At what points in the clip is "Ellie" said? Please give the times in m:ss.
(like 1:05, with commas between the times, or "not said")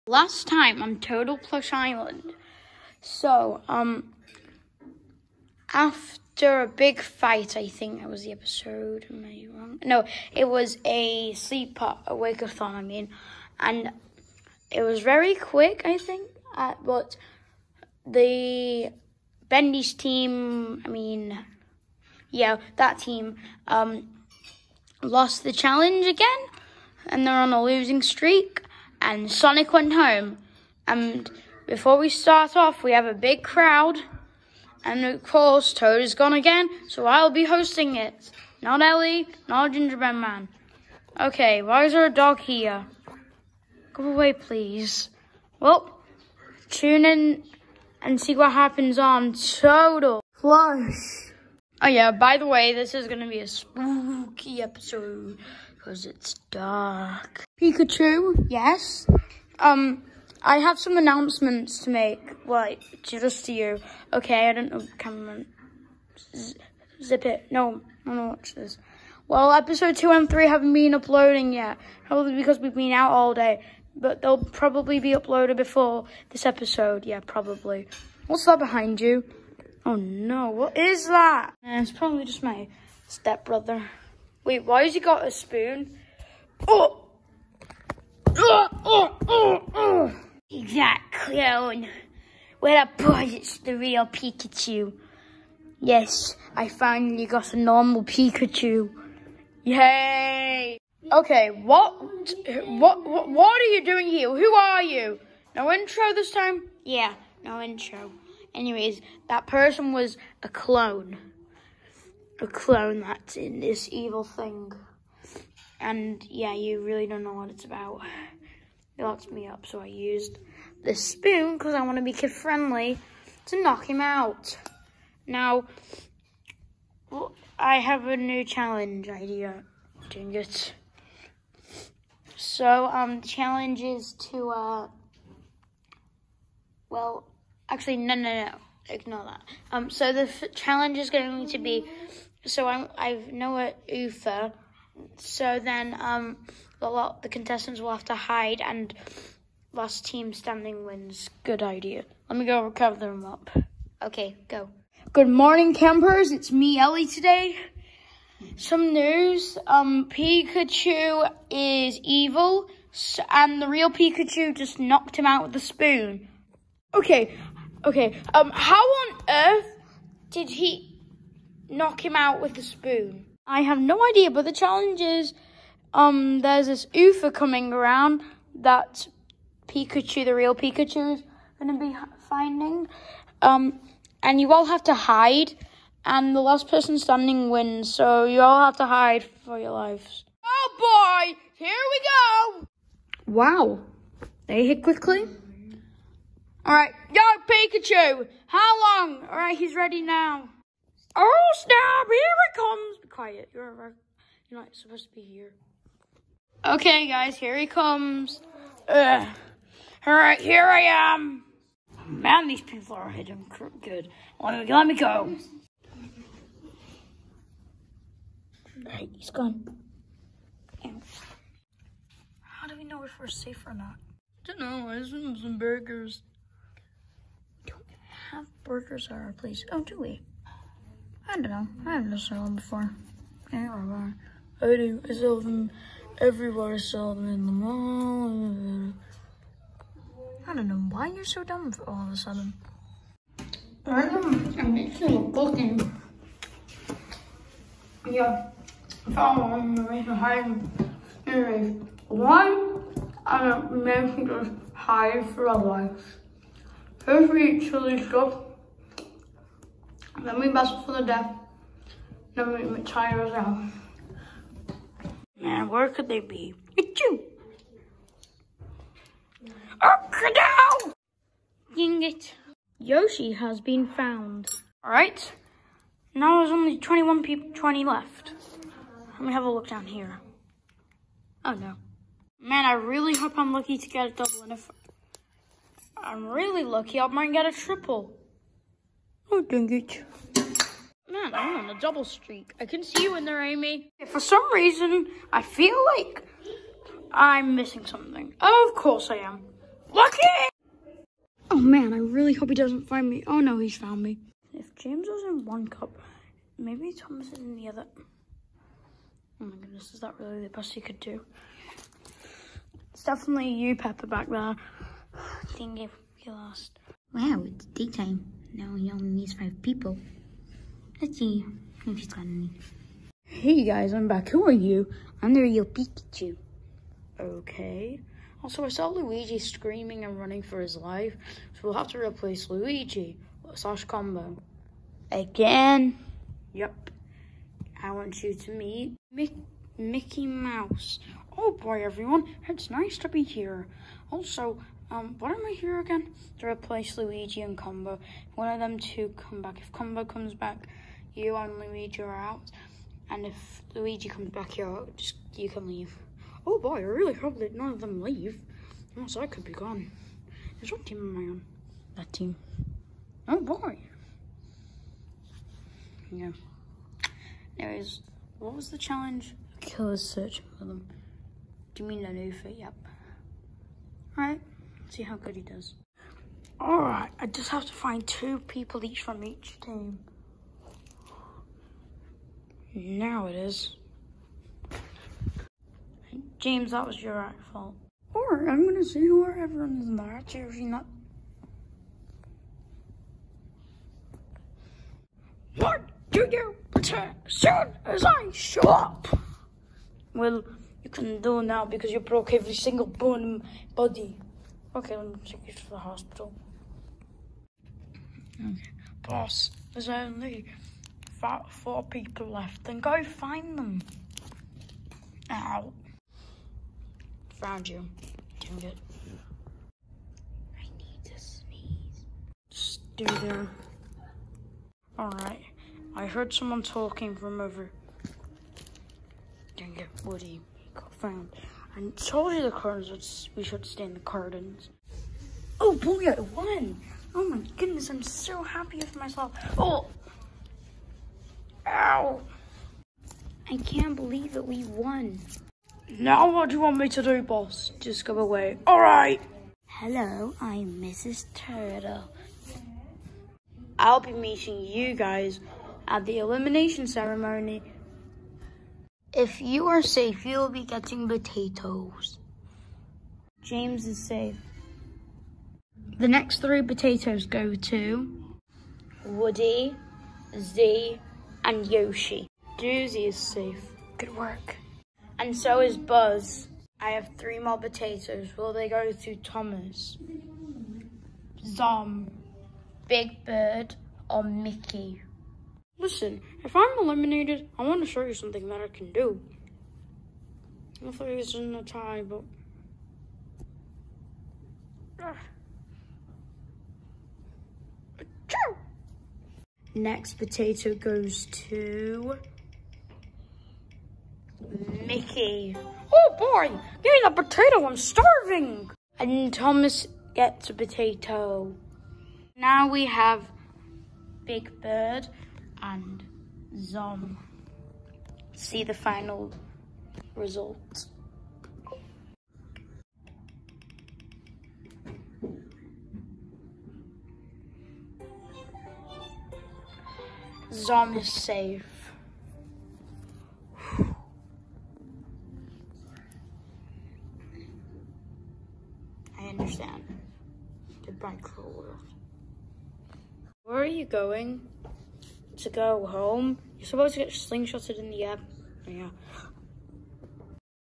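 0:38, 2:36.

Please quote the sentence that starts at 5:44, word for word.
Also, um, what am I here again?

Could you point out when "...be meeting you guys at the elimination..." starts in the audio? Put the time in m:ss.
7:33.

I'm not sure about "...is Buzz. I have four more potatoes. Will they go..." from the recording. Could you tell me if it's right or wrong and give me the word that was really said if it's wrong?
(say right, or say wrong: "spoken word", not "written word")
wrong: "three", not "four".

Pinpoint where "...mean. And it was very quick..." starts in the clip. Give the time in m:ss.
0:12.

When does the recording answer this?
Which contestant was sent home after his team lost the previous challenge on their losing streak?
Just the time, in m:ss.
0:29.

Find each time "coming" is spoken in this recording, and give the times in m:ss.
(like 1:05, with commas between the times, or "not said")
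2:57.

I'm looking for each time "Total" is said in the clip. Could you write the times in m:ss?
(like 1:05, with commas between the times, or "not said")
0:00, 0:49.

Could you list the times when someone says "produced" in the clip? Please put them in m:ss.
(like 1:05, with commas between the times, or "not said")
not said.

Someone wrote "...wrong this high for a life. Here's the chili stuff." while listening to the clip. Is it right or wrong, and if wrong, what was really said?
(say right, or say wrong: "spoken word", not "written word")
wrong: "making", not "wrong".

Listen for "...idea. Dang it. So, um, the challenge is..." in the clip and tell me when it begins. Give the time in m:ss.
2:09.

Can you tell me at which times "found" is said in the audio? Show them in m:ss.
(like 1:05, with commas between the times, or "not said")
4:33, 5:03, 6:57, 7:10.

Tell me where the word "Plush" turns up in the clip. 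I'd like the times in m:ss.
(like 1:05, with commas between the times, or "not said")
0:01, 0:50.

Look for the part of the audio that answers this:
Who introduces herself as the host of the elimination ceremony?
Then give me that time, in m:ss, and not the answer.
7:30.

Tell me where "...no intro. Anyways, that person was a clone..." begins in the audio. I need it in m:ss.
1:47.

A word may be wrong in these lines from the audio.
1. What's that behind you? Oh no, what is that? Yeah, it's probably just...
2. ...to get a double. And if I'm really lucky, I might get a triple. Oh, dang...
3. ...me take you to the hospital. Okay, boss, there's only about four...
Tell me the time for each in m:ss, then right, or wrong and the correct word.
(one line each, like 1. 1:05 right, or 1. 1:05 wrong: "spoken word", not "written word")
1. 1:18 right
2. 4:43 right
3. 6:45 right.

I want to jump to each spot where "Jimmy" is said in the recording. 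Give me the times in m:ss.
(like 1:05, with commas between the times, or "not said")
6:11.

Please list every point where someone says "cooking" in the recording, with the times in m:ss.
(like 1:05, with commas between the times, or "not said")
4:05.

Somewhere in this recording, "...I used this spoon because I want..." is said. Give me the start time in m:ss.
1:59.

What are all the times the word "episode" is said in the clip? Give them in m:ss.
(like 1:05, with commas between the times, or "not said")
0:08, 0:54, 1:09, 1:16.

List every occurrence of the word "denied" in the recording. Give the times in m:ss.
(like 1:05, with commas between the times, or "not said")
not said.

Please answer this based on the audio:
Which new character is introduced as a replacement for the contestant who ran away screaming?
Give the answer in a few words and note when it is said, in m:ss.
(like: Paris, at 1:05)
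Mickey Mouse, at 5:39.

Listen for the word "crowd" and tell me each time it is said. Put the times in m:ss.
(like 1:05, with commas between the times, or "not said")
0:33.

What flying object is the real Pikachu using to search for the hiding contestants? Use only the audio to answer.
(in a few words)
UFO.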